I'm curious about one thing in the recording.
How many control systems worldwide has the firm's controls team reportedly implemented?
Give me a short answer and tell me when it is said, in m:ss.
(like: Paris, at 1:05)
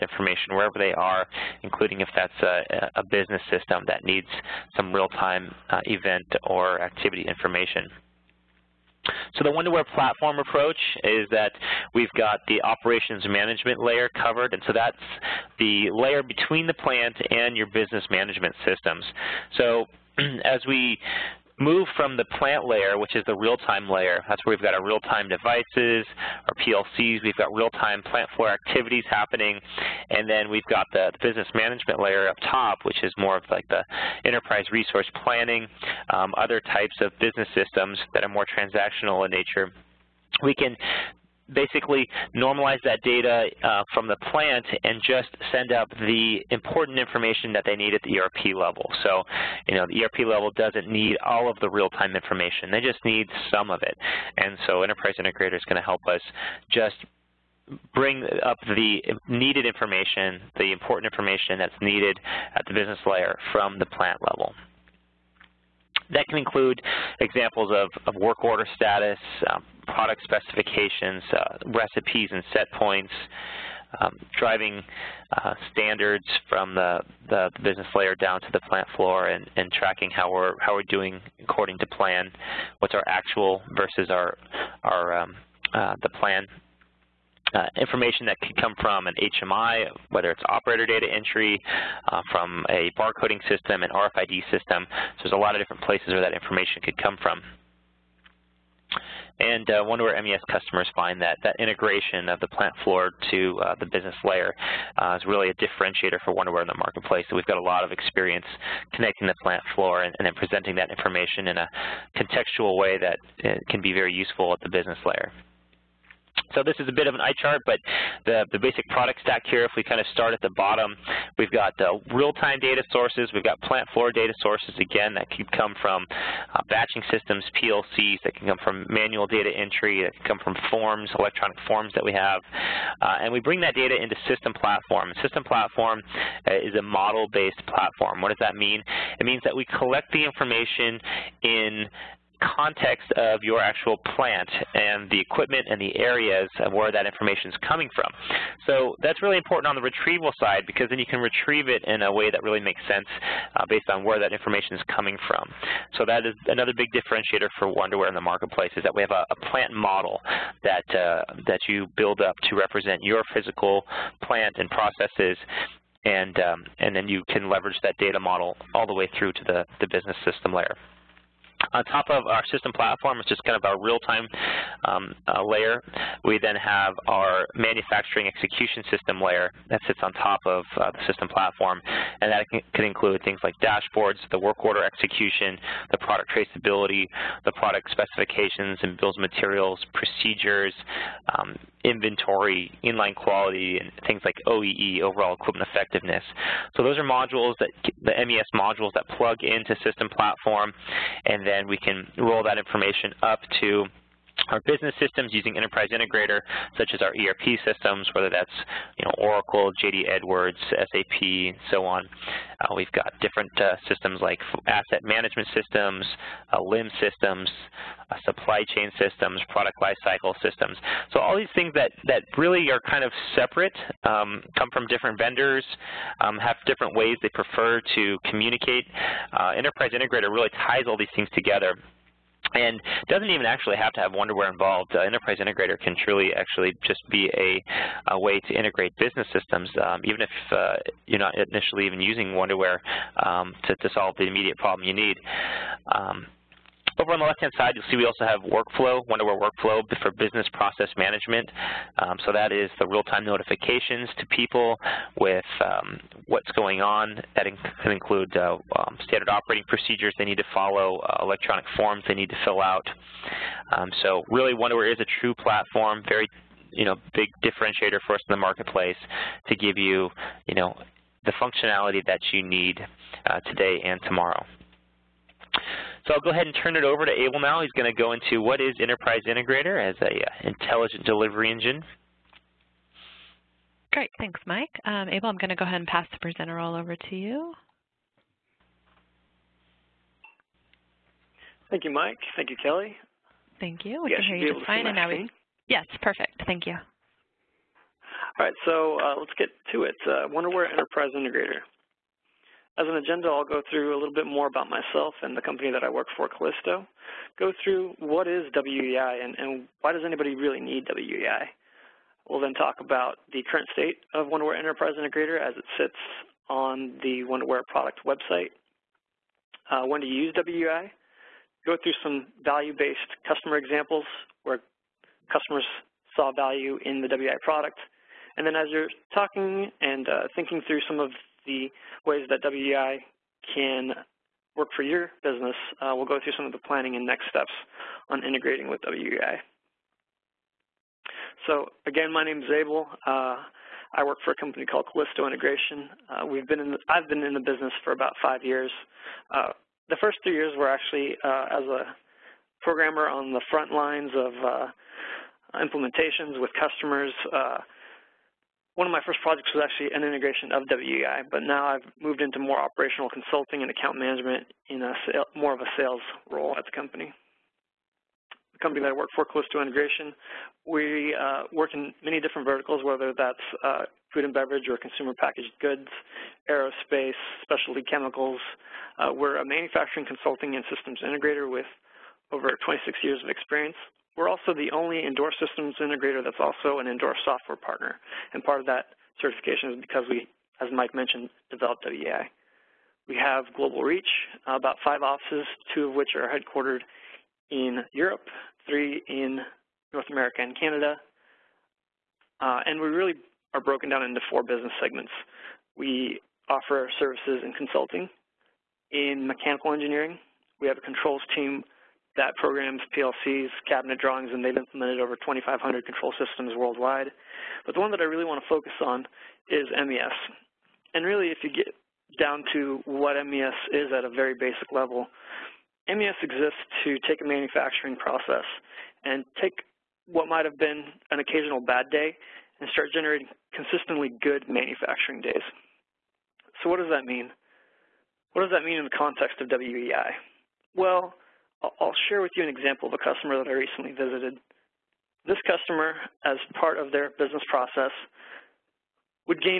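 2,500, at 6:55.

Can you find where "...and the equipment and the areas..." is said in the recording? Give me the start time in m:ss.
2:24.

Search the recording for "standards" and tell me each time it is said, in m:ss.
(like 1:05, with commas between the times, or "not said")
1:15, 4:19.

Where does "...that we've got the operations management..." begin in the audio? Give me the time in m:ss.
0:11.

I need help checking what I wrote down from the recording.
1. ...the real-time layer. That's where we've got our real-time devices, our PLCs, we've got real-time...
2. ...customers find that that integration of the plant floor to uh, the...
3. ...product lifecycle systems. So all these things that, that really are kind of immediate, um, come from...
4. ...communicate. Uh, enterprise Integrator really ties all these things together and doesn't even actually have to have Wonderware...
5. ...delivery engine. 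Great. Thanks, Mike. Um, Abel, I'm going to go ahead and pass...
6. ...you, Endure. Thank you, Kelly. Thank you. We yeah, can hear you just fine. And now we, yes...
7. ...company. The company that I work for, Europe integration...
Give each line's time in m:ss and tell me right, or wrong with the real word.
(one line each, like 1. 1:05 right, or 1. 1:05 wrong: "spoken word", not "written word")
1. 0:23 right
2. 1:40 right
3. 3:39 wrong: "separate", not "immediate"
4. 3:48 right
5. 4:41 right
6. 4:51 wrong: "Mike", not "Endure"
7. 6:06 wrong: "Callisto", not "Europe".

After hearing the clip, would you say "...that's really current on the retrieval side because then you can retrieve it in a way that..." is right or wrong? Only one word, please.
wrong.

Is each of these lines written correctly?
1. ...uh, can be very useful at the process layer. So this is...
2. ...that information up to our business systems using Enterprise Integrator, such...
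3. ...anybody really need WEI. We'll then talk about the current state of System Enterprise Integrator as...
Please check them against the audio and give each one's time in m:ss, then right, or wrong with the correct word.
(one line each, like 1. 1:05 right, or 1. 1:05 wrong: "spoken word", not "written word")
1. 1:53 wrong: "business", not "process"
2. 3:22 right
3. 5:10 wrong: "WonderWare", not "System".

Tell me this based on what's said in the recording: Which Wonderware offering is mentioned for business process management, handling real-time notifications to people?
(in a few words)
Wonderware Workflow.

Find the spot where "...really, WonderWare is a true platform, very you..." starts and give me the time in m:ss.
4:24.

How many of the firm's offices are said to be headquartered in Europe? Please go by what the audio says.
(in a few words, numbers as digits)
2.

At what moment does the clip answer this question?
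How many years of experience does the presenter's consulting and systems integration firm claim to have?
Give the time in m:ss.
6:22.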